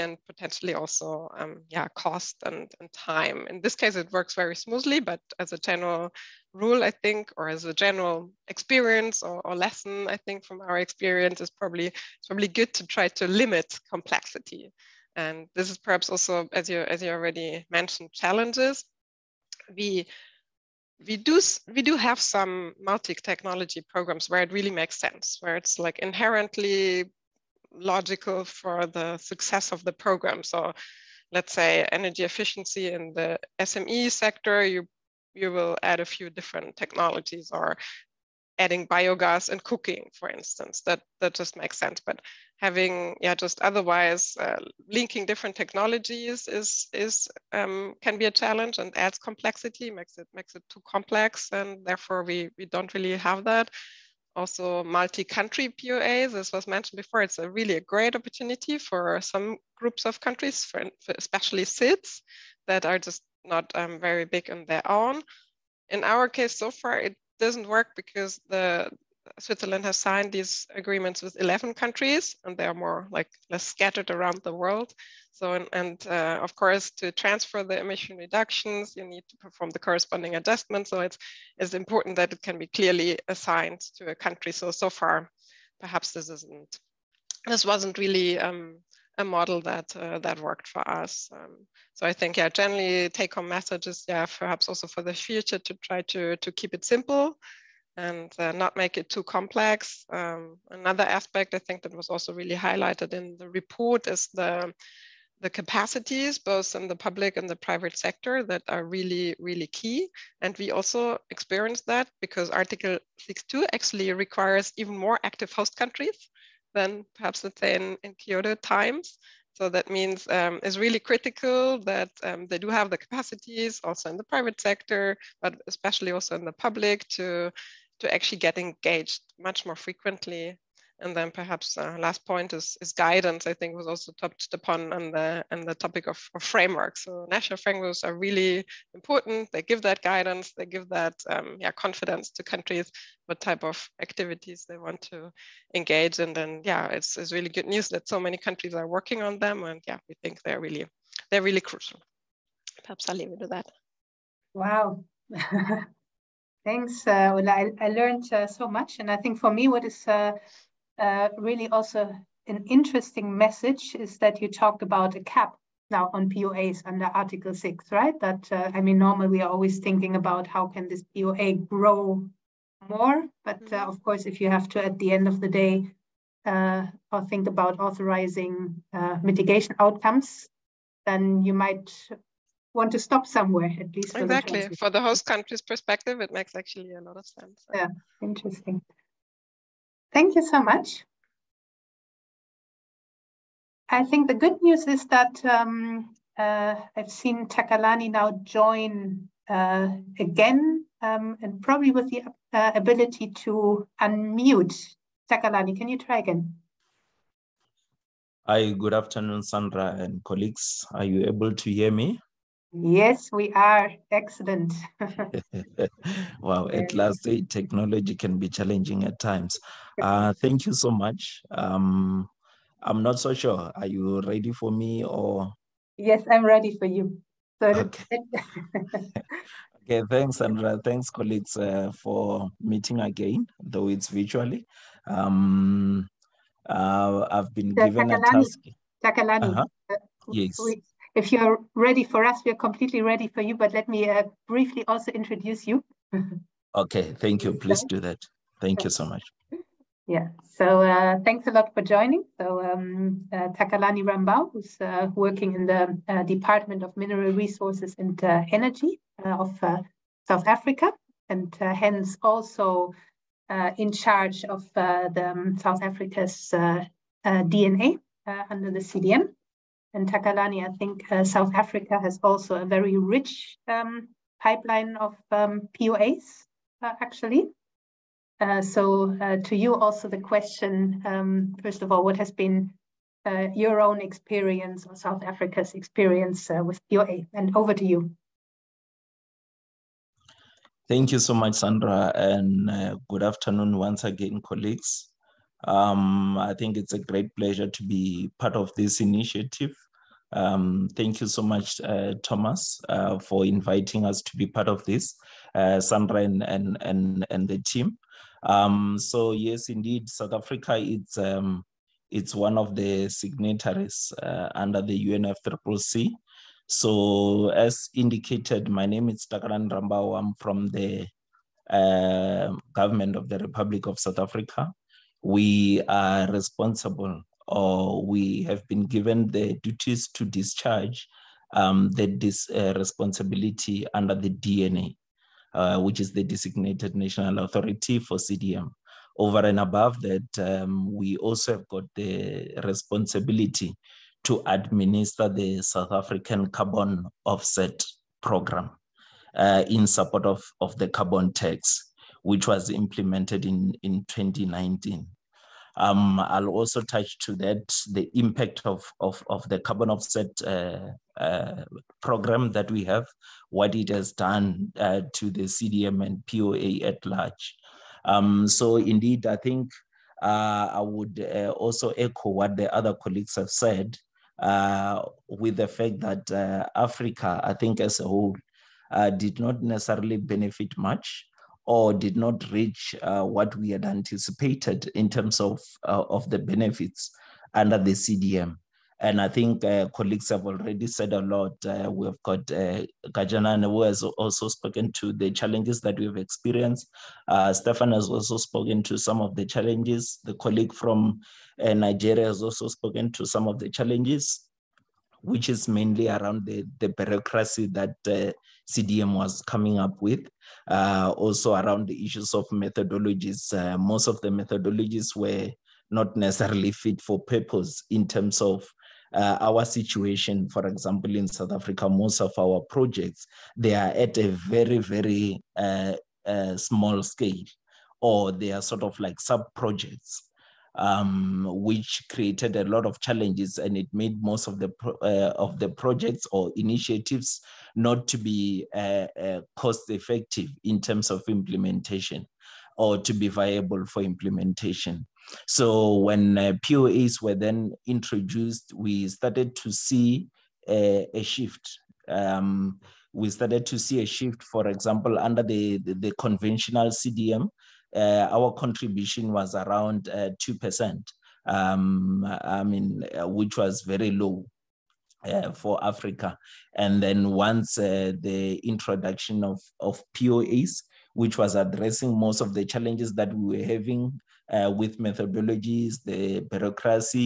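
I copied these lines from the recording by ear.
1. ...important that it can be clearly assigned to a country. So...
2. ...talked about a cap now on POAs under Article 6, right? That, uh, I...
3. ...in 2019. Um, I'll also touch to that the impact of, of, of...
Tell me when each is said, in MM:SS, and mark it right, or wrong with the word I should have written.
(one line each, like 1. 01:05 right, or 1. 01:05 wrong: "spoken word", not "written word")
1. 01:21 right
2. 02:44 right
3. 05:53 right.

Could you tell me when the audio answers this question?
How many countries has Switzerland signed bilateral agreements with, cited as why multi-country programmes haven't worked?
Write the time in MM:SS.
01:11.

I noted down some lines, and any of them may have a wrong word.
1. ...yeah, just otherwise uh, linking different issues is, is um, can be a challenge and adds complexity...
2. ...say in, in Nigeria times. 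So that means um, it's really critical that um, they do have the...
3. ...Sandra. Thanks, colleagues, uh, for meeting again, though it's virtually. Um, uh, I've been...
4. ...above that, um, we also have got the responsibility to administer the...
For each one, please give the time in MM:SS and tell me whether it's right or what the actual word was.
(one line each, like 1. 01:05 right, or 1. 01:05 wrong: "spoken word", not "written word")
1. 00:43 wrong: "technologies", not "issues"
2. 01:57 wrong: "Kyoto", not "Nigeria"
3. 03:50 right
4. 05:39 right.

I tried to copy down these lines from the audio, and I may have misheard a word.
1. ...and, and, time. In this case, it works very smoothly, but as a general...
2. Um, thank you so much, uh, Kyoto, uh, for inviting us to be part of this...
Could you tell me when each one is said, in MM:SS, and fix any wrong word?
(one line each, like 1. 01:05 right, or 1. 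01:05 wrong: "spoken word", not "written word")
1. 00:02 right
2. 05:00 wrong: "Thomas", not "Kyoto".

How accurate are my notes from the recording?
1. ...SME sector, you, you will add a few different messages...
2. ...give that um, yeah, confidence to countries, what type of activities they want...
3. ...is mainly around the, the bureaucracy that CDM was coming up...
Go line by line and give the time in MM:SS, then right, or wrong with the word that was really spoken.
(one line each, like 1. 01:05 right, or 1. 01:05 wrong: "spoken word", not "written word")
1. 00:33 wrong: "technologies", not "messages"
2. 02:20 right
3. 06:45 right.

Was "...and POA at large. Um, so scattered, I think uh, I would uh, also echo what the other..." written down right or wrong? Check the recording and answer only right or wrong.
wrong.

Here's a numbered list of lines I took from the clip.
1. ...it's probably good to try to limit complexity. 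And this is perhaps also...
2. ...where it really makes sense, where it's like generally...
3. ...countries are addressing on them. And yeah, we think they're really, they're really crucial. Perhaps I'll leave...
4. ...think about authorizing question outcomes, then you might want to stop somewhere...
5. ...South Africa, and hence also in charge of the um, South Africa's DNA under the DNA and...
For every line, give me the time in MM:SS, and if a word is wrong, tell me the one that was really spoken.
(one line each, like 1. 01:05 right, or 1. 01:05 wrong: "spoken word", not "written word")
1. 00:11 right
2. 00:24 wrong: "inherently", not "generally"
3. 02:28 wrong: "working", not "addressing"
4. 02:57 wrong: "mitigation", not "question"
5. 04:20 wrong: "CDM", not "DNA".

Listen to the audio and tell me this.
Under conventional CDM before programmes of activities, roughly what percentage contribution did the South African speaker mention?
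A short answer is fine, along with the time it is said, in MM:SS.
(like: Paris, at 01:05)
2%, at 07:40.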